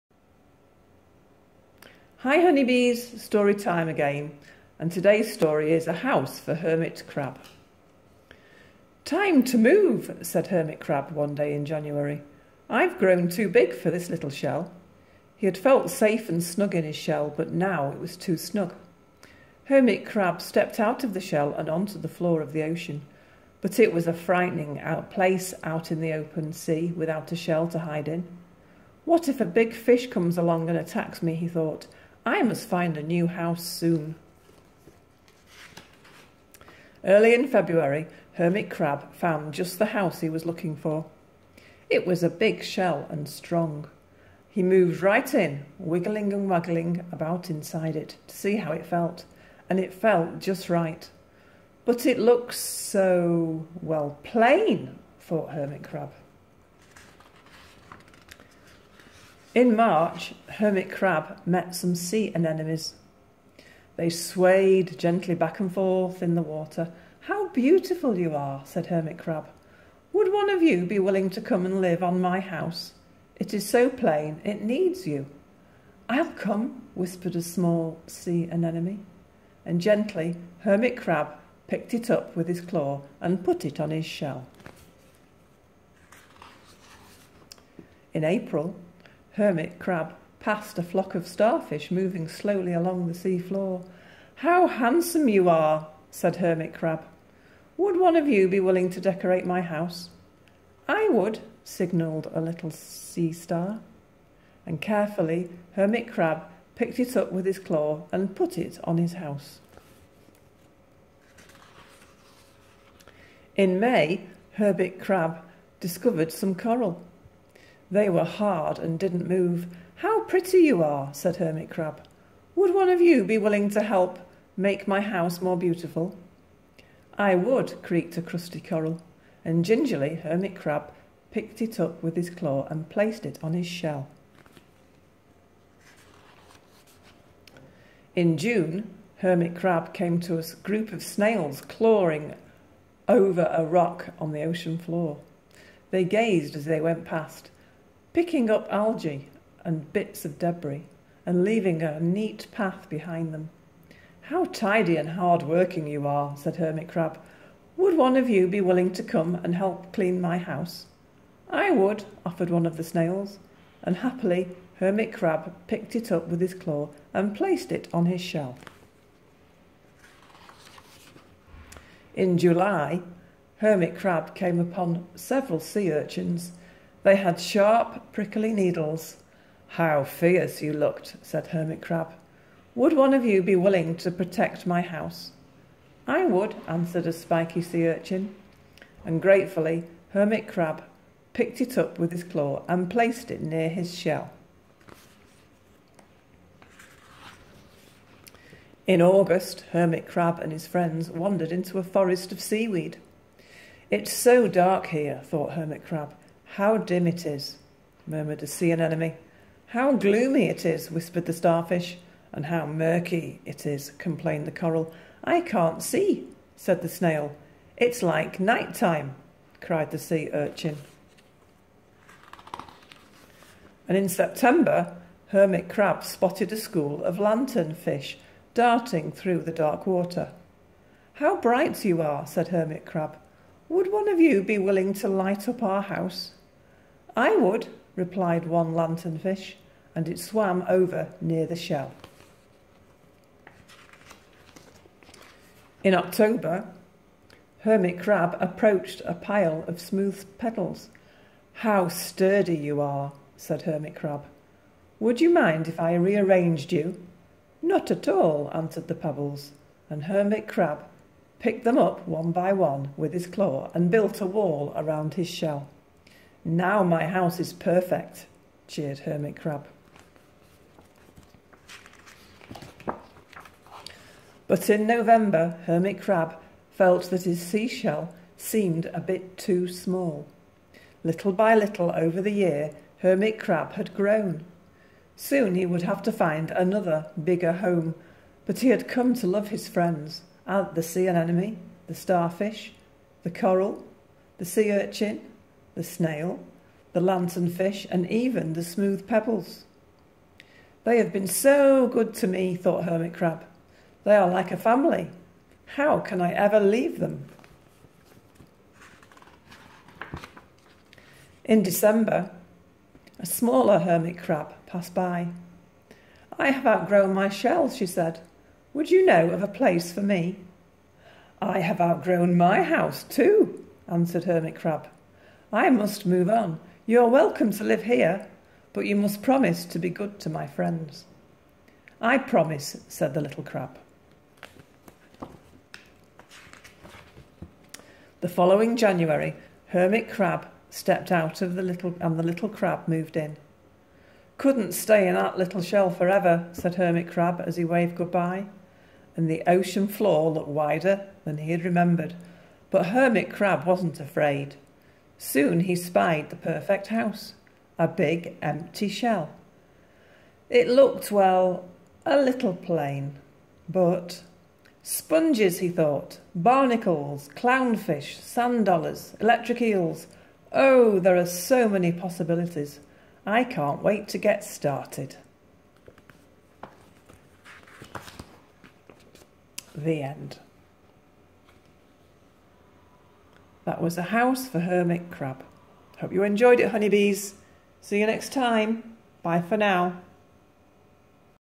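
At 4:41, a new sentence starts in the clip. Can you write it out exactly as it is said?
Little by little over the year, Hermit Crab had grown.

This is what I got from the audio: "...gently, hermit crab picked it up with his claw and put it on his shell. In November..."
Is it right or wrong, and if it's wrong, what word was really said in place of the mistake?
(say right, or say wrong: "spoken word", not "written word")
wrong: "April", not "November".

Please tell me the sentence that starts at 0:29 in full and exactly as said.
What if a big fish comes along and attacks me, he thought, I must find a new house soon.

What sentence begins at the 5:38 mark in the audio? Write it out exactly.
The following January, Hermit Crab stepped out of the little and the little crab moved in.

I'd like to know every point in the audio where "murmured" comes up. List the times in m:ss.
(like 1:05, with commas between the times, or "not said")
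3:28.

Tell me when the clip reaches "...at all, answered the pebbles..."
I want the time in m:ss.
4:17.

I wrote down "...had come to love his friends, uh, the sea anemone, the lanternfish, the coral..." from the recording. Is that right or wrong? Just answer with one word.
wrong.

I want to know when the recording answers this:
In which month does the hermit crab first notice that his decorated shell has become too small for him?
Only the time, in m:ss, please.
4:34.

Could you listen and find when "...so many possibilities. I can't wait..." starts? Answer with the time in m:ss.
6:11.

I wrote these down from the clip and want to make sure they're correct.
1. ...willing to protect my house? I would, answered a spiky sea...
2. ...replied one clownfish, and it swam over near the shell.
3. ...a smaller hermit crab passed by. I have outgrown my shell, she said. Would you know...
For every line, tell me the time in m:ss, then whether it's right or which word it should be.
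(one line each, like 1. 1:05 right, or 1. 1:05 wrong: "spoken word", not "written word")
1. 3:03 right
2. 3:57 wrong: "lanternfish", not "clownfish"
3. 5:13 right.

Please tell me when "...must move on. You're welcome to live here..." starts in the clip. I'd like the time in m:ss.
5:25.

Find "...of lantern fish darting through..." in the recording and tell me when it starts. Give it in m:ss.
3:47.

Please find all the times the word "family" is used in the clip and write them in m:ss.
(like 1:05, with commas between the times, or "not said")
5:04.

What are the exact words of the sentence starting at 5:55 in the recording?
Soon he spied the perfect house, a big empty shell.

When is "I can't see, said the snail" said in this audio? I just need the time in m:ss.
3:35.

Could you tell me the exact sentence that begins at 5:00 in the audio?
They have been so good to me, thought Hermit Crab.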